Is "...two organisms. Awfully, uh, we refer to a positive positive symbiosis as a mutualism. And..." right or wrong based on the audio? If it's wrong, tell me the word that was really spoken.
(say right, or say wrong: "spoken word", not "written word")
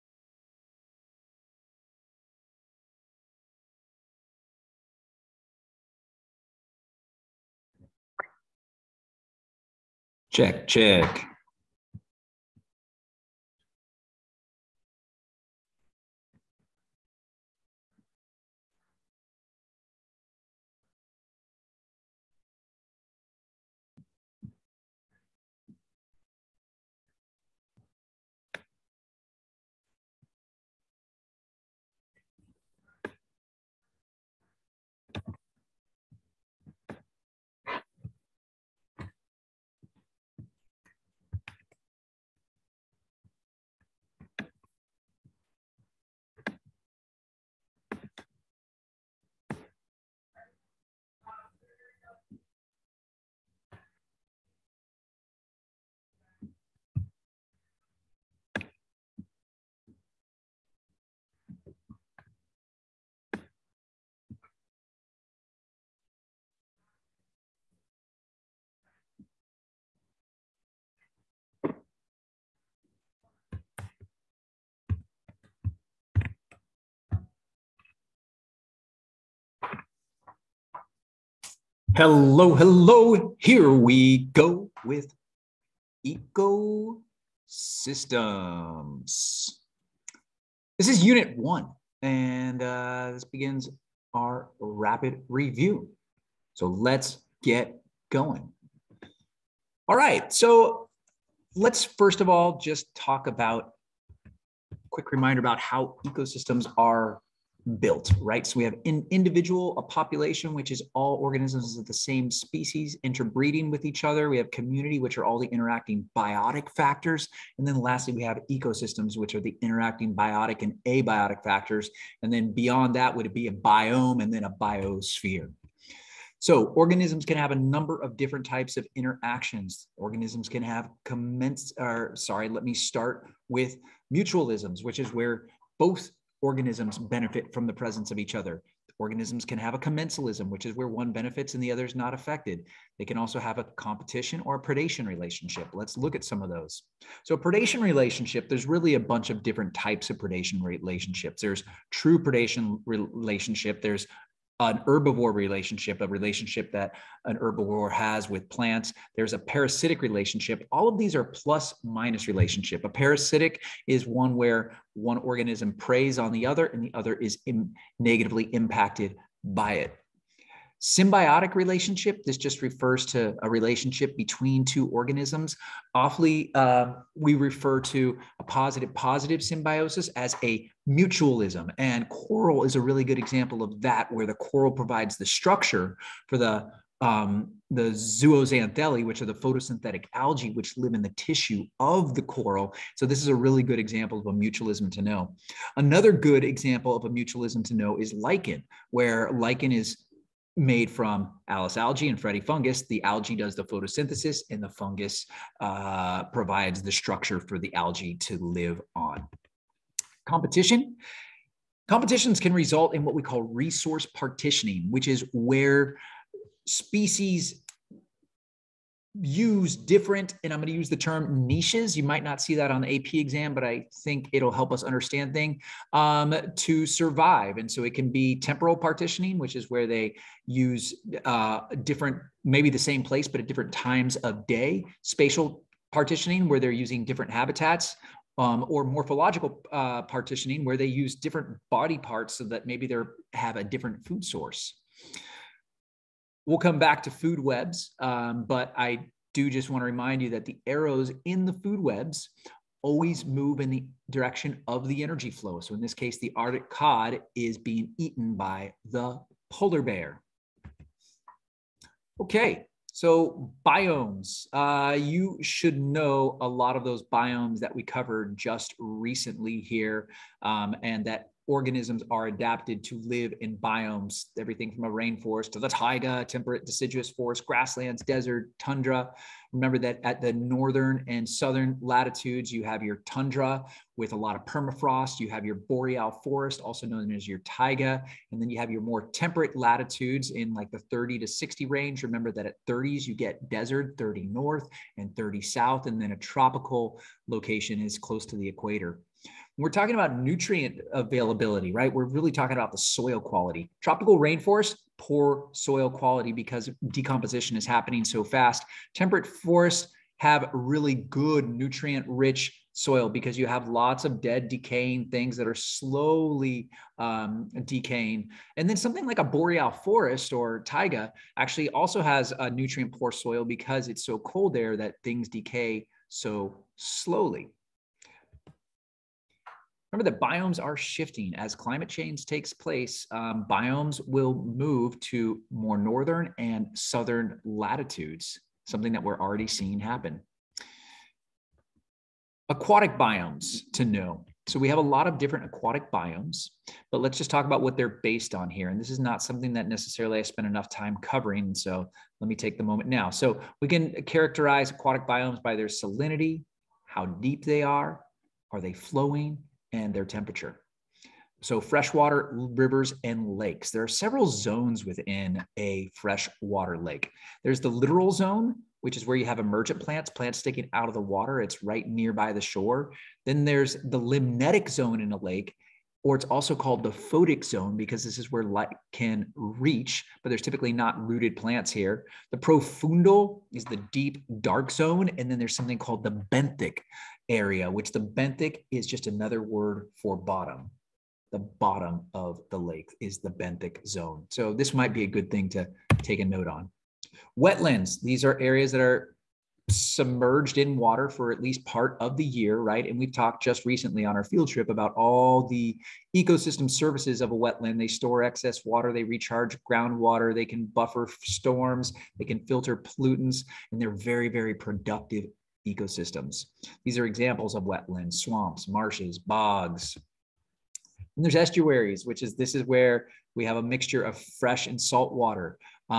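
right.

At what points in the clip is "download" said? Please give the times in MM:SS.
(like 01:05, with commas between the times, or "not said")
not said.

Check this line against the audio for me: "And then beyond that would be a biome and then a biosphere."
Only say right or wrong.
right.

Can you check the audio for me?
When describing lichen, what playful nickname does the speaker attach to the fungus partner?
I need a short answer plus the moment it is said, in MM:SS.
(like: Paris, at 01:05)
Freddy fungus, at 03:22.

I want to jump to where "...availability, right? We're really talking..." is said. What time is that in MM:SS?
05:00.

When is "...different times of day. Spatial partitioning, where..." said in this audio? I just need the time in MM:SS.
03:53.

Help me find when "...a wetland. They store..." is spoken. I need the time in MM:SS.
06:47.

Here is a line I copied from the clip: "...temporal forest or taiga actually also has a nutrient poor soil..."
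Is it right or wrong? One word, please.
wrong.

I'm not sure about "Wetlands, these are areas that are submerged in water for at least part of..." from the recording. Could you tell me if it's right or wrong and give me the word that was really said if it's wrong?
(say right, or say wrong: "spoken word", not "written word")
right.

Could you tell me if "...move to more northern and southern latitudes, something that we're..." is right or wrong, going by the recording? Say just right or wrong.
right.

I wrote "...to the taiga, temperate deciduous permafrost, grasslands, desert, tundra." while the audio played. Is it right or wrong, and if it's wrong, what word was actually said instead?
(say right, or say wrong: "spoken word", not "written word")
wrong: "forest", not "permafrost".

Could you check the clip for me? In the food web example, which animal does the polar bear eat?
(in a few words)
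Arctic cod.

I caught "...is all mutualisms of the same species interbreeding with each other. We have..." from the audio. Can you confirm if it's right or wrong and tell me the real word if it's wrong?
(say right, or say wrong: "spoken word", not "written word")
wrong: "organisms", not "mutualisms".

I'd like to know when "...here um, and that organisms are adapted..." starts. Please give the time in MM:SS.
04:29.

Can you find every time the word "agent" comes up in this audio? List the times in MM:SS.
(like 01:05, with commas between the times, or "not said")
not said.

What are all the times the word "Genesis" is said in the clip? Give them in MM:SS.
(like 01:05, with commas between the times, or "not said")
not said.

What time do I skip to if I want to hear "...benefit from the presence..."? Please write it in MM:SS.
02:16.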